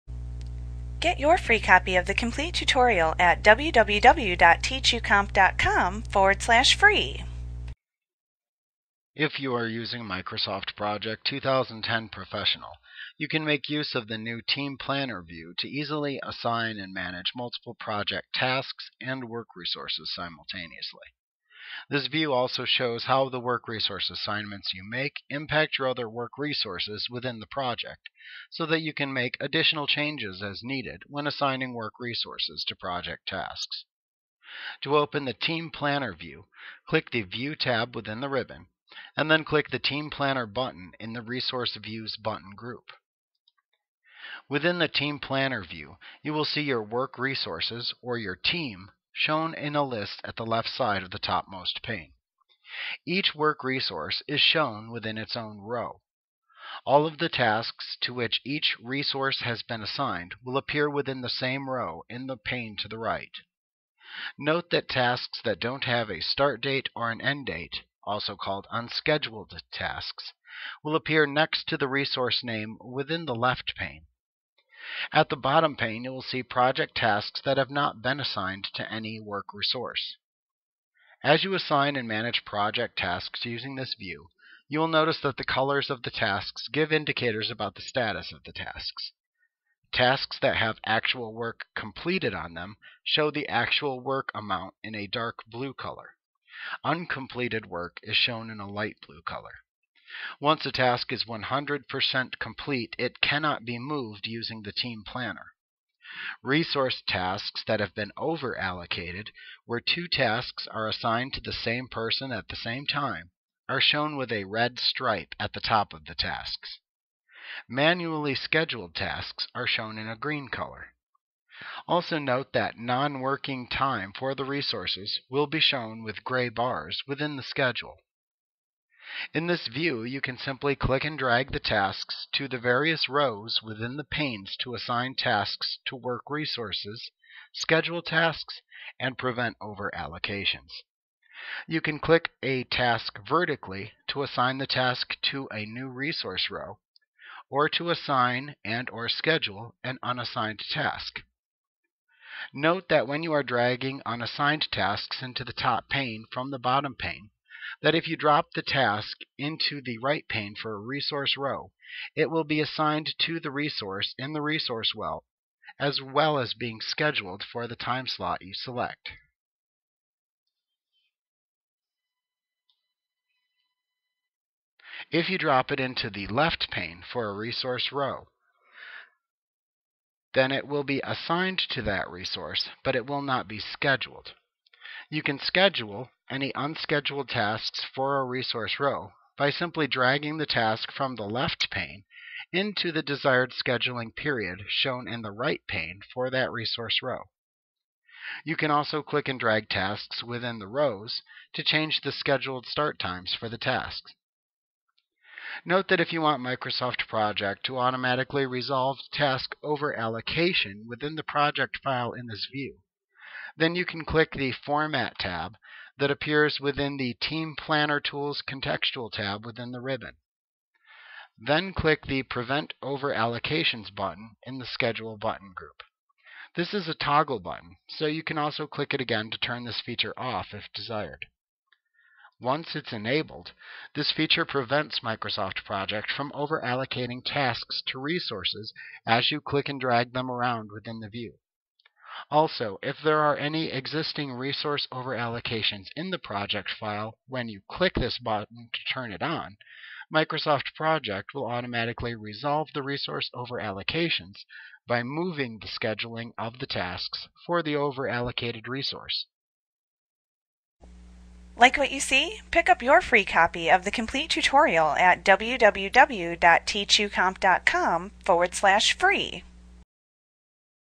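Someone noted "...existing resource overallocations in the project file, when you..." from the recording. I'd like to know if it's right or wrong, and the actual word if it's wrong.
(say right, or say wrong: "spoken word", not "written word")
right.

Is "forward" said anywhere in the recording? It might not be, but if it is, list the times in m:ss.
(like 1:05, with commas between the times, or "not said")
0:06, 4:28.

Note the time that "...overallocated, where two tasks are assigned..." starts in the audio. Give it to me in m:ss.
1:48.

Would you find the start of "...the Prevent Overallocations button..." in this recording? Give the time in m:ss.
3:42.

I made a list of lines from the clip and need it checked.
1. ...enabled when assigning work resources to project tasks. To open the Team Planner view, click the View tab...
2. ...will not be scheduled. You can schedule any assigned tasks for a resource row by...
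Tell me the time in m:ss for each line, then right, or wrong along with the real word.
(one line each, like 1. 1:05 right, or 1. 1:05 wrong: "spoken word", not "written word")
1. 0:30 wrong: "needed", not "enabled"
2. 3:03 wrong: "unscheduled", not "assigned".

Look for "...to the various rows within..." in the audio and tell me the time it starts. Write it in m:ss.
2:12.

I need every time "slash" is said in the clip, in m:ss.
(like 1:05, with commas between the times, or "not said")
0:06, 4:28.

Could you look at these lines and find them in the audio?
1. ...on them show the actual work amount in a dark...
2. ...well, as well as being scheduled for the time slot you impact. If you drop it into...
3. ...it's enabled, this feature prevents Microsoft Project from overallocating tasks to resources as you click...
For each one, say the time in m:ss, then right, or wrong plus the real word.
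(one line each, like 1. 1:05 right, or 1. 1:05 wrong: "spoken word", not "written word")
1. 1:32 right
2. 2:44 wrong: "select", not "impact"
3. 3:52 right.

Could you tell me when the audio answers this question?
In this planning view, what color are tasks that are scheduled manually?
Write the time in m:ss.
2:00.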